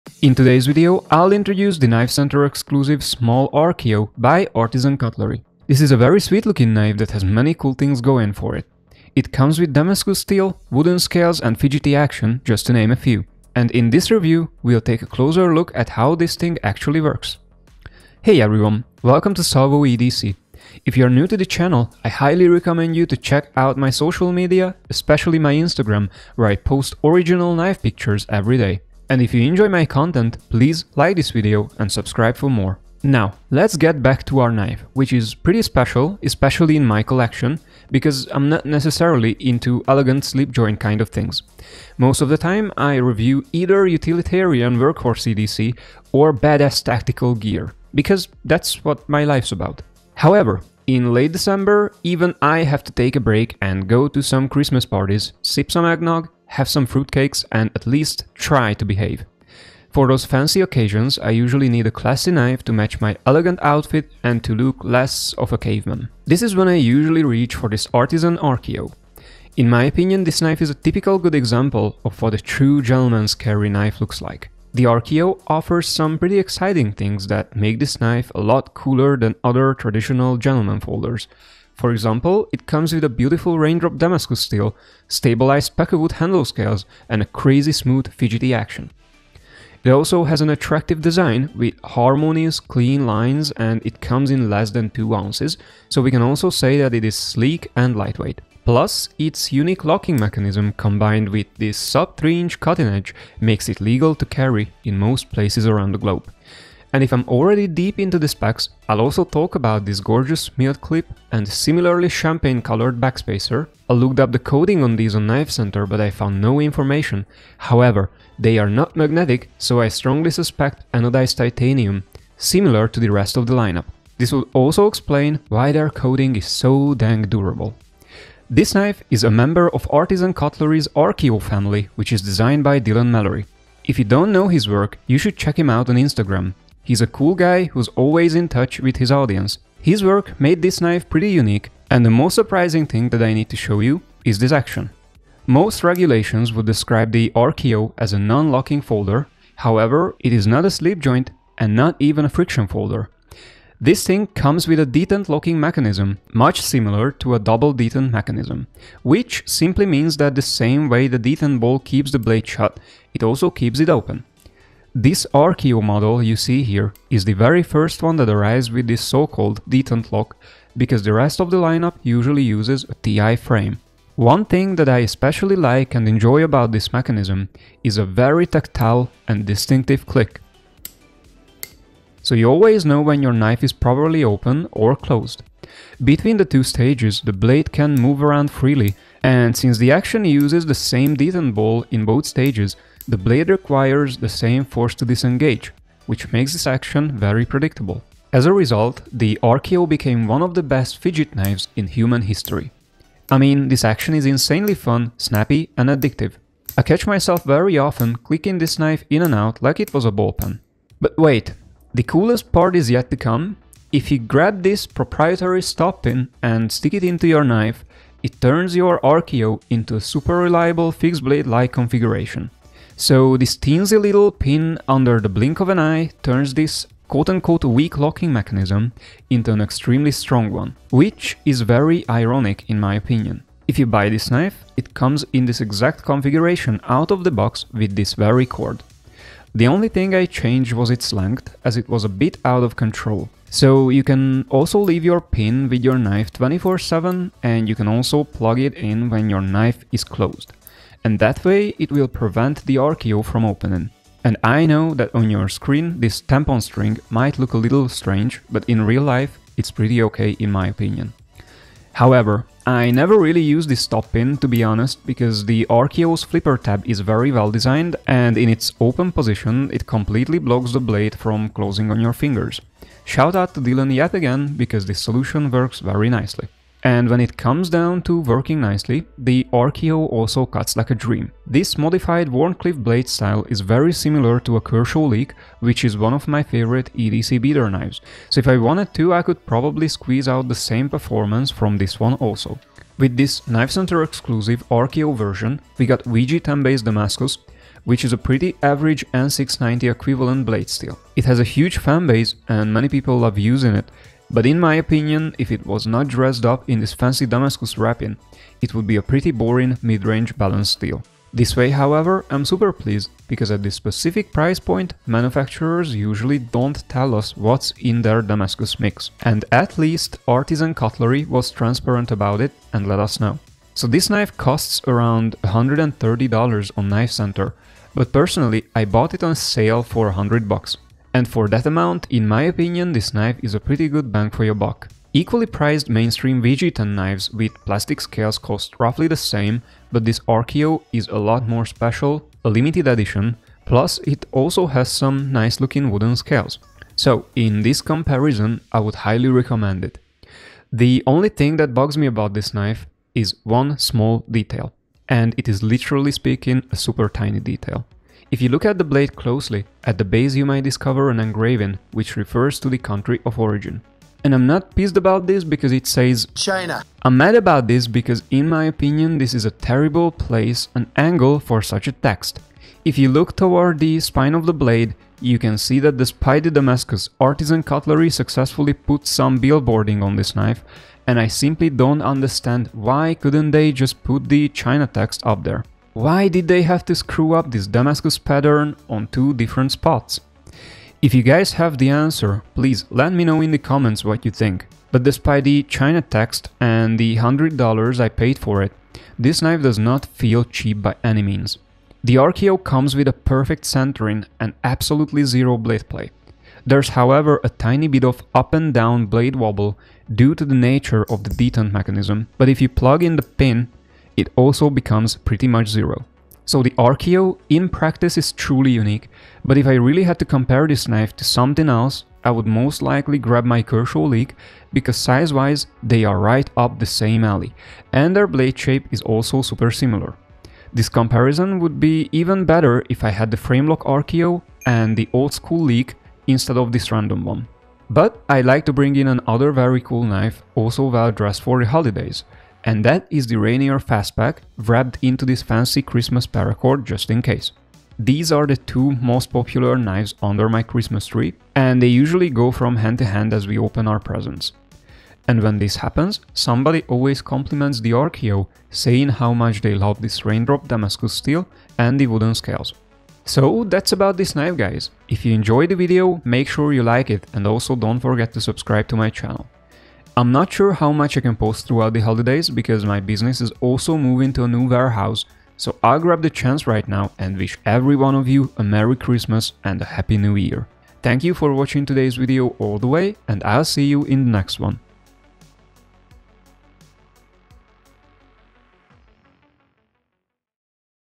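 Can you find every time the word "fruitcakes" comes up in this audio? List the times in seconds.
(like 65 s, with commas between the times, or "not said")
56 s.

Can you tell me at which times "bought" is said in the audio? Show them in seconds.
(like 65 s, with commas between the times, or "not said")
328 s.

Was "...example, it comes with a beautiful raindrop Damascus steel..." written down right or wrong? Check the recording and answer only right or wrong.
right.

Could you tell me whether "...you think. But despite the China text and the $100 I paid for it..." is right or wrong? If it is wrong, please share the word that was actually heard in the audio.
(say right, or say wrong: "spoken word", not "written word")
right.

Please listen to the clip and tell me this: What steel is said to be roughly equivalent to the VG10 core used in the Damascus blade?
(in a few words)
N690.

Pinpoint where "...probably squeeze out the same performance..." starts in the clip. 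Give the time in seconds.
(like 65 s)
289 s.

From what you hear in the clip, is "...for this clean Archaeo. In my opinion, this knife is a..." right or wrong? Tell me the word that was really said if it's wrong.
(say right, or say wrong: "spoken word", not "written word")
wrong: "artisan", not "clean".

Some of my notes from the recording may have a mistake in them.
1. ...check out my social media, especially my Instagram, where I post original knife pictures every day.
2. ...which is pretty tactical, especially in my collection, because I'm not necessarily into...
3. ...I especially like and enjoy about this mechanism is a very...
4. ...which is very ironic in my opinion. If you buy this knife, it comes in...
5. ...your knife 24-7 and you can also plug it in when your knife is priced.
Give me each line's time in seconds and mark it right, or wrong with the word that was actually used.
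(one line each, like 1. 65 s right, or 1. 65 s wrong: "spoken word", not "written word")
1. 23 s right
2. 34 s wrong: "special", not "tactical"
3. 174 s right
4. 230 s right
5. 245 s wrong: "closed", not "priced".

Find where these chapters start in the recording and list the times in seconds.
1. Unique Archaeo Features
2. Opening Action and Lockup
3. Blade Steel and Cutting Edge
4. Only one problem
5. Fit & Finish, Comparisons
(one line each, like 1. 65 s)
1. 74 s
2. 144 s
3. 292 s
4. 350 s
5. 394 s.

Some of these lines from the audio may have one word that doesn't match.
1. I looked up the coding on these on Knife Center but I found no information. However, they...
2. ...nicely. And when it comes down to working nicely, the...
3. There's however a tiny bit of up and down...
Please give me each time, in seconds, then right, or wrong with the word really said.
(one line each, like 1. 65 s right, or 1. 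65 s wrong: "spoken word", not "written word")
1. 113 s right
2. 276 s right
3. 406 s right.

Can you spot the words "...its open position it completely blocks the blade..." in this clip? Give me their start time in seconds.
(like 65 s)
268 s.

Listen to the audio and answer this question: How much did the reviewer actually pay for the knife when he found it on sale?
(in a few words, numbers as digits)
$100.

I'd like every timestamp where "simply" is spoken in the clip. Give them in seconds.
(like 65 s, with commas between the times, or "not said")
159 s, 381 s.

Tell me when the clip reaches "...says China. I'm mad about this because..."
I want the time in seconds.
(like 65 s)
365 s.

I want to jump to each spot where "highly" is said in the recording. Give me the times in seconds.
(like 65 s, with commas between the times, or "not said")
22 s, 348 s.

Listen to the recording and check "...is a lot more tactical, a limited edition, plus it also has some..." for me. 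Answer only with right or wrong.
wrong.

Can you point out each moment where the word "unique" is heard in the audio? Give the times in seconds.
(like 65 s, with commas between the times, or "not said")
99 s, 141 s, 418 s.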